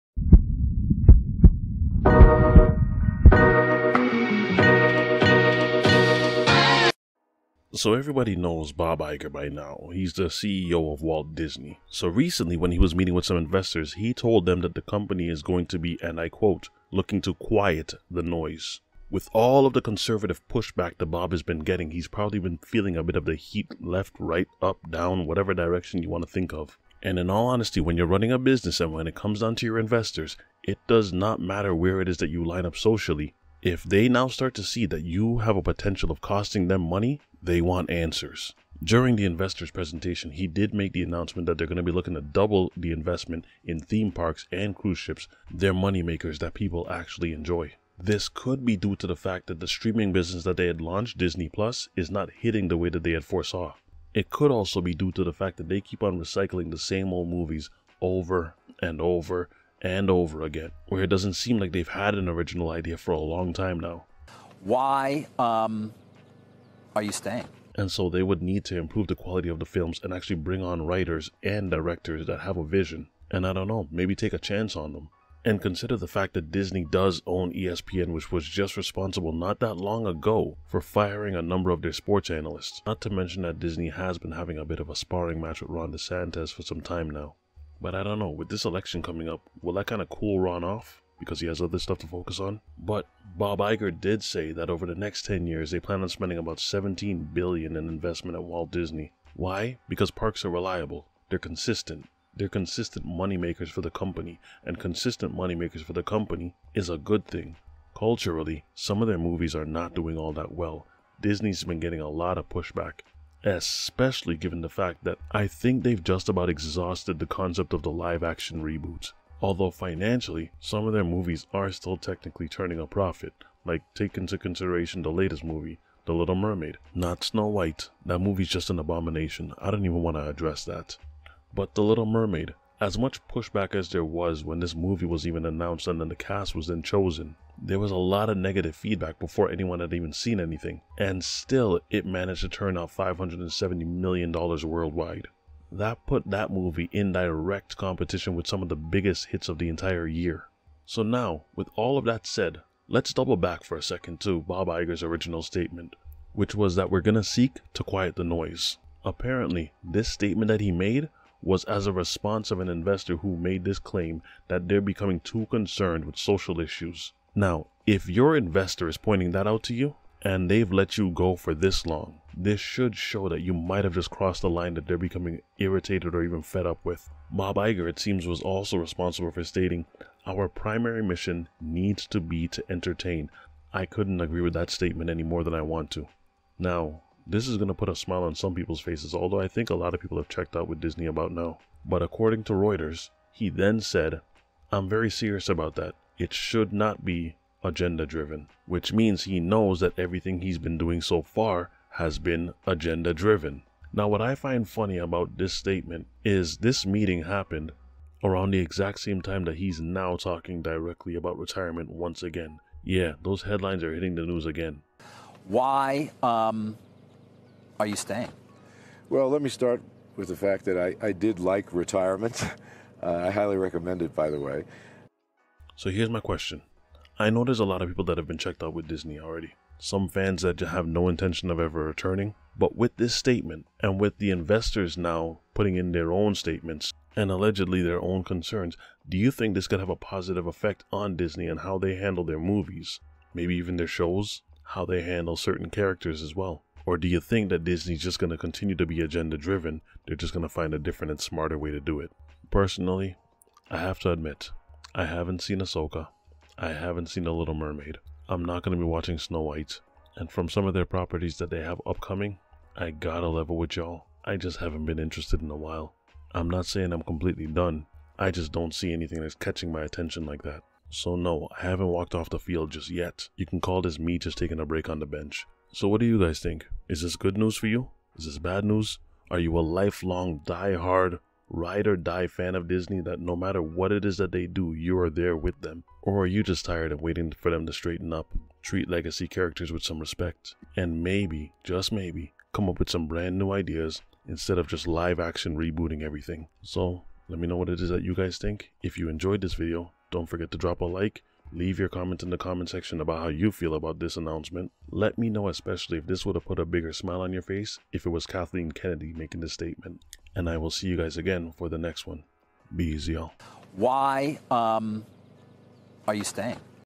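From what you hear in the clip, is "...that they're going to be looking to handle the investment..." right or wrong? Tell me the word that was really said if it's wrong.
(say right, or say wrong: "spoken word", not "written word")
wrong: "double", not "handle".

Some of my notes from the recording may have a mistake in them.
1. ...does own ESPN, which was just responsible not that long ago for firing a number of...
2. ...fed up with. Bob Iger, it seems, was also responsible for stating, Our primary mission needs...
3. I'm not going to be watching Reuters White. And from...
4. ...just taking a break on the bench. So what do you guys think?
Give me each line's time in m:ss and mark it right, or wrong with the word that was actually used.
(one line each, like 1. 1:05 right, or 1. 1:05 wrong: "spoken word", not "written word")
1. 1:16 right
2. 2:56 right
3. 4:18 wrong: "Snow", not "Reuters"
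4. 4:34 right.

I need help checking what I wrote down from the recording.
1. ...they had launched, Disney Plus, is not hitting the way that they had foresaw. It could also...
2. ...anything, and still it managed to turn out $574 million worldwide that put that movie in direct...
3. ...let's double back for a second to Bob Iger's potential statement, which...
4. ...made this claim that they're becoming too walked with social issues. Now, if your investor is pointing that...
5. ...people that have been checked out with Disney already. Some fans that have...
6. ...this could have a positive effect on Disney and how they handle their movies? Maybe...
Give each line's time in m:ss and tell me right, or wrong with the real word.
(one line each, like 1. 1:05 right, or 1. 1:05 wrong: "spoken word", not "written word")
1. 0:50 right
2. 2:20 wrong: "570", not "574"
3. 2:32 wrong: "original", not "potential"
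4. 2:43 wrong: "concerned", not "walked"
5. 3:47 right
6. 3:59 right.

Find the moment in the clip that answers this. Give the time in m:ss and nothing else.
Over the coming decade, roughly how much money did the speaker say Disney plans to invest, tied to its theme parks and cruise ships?
1:36.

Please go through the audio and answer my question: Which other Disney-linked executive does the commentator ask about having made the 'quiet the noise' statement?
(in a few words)
Kathleen Kennedy.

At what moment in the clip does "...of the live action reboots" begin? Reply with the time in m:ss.
1:57.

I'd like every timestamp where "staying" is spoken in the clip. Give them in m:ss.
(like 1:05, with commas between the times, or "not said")
1:07, 3:37, 5:16.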